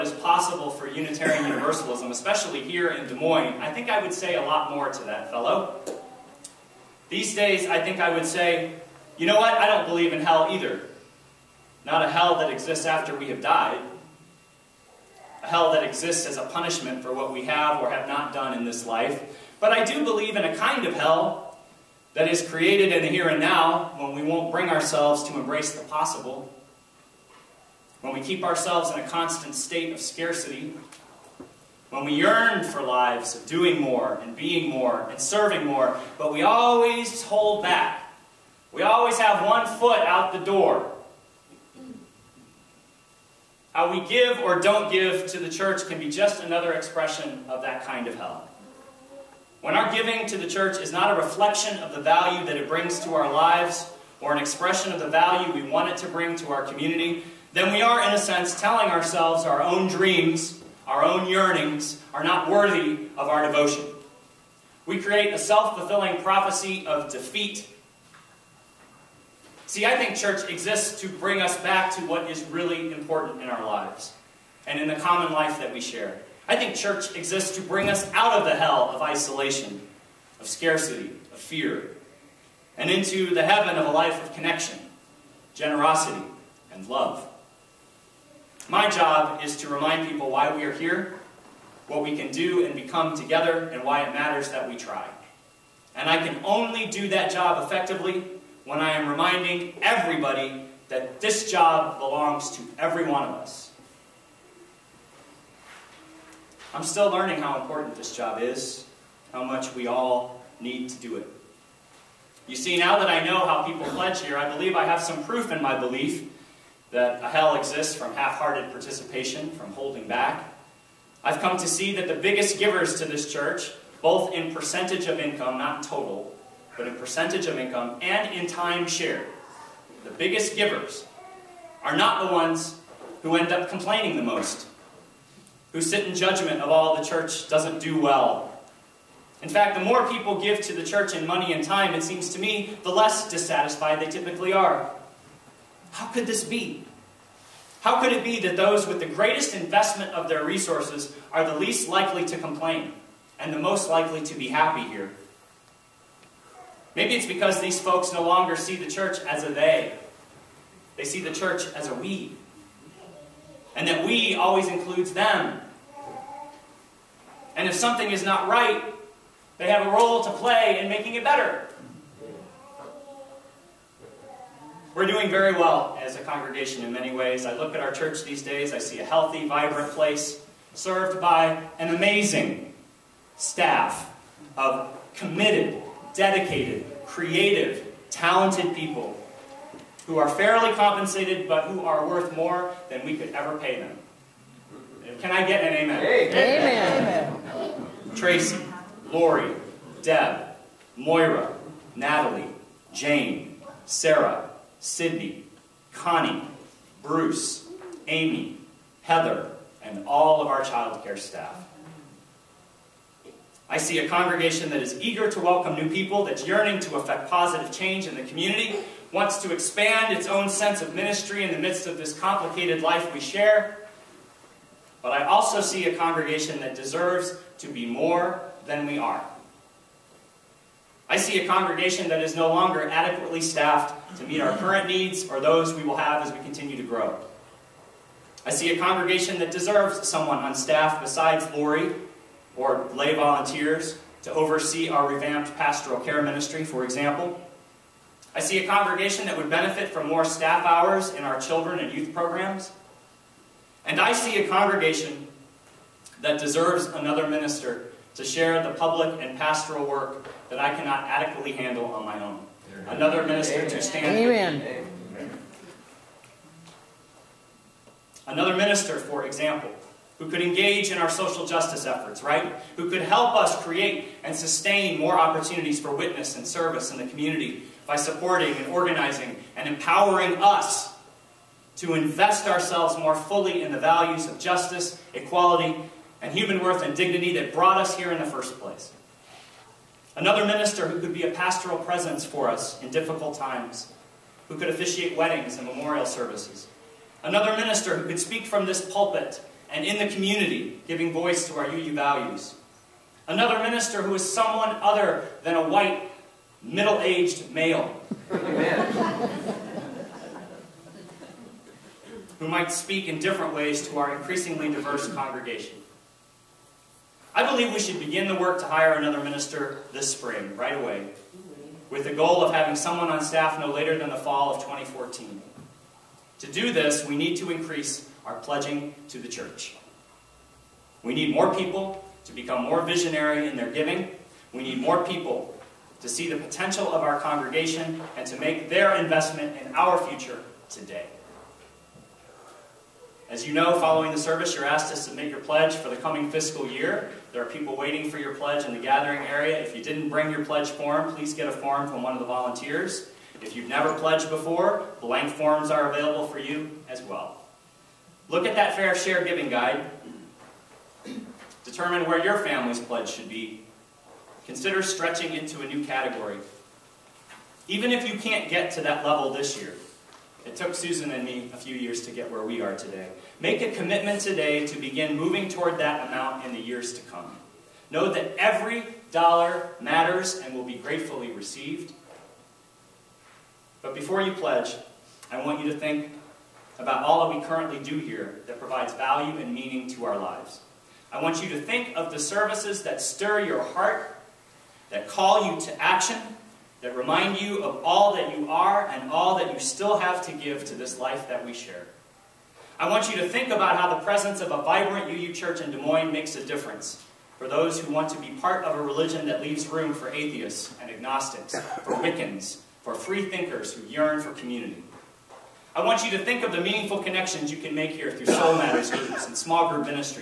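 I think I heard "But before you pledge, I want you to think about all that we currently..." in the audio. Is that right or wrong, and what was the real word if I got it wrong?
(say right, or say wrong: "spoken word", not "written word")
right.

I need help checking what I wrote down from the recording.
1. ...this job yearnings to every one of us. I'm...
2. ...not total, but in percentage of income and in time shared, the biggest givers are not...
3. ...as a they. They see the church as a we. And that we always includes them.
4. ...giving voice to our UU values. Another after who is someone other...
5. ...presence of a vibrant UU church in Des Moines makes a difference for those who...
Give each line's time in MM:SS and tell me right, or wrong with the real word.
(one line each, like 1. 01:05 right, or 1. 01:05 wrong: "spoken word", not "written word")
1. 01:41 wrong: "belongs", not "yearnings"
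2. 02:05 right
3. 02:39 right
4. 05:00 wrong: "minister", not "after"
5. 06:44 right.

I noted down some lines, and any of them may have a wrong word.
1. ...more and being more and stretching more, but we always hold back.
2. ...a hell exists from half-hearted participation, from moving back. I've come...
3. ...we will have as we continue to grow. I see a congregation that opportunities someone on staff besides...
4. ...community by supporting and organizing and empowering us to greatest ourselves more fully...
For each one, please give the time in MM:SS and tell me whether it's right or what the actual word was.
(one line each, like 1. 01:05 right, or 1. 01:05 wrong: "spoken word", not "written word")
1. 00:33 wrong: "serving", not "stretching"
2. 01:57 wrong: "holding", not "moving"
3. 03:55 wrong: "deserves", not "opportunities"
4. 04:37 wrong: "invest", not "greatest".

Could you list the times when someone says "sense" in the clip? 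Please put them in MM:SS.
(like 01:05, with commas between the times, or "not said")
00:58, 03:40.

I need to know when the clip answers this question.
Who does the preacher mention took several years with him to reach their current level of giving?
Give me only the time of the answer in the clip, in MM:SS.
06:10.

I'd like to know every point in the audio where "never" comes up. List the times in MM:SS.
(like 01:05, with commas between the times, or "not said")
05:53.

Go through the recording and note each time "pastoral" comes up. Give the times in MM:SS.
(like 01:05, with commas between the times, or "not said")
04:05, 04:19, 04:51.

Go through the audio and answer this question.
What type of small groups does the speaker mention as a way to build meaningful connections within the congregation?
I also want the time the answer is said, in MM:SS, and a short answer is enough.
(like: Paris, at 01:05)
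Soul Matters groups, at 06:58.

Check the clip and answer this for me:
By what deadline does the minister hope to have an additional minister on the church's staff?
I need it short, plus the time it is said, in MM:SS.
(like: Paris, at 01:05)
fall of 2014, at 05:24.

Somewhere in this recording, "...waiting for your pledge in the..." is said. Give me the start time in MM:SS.
05:47.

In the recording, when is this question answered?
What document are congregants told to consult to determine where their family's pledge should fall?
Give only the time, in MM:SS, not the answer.
05:58.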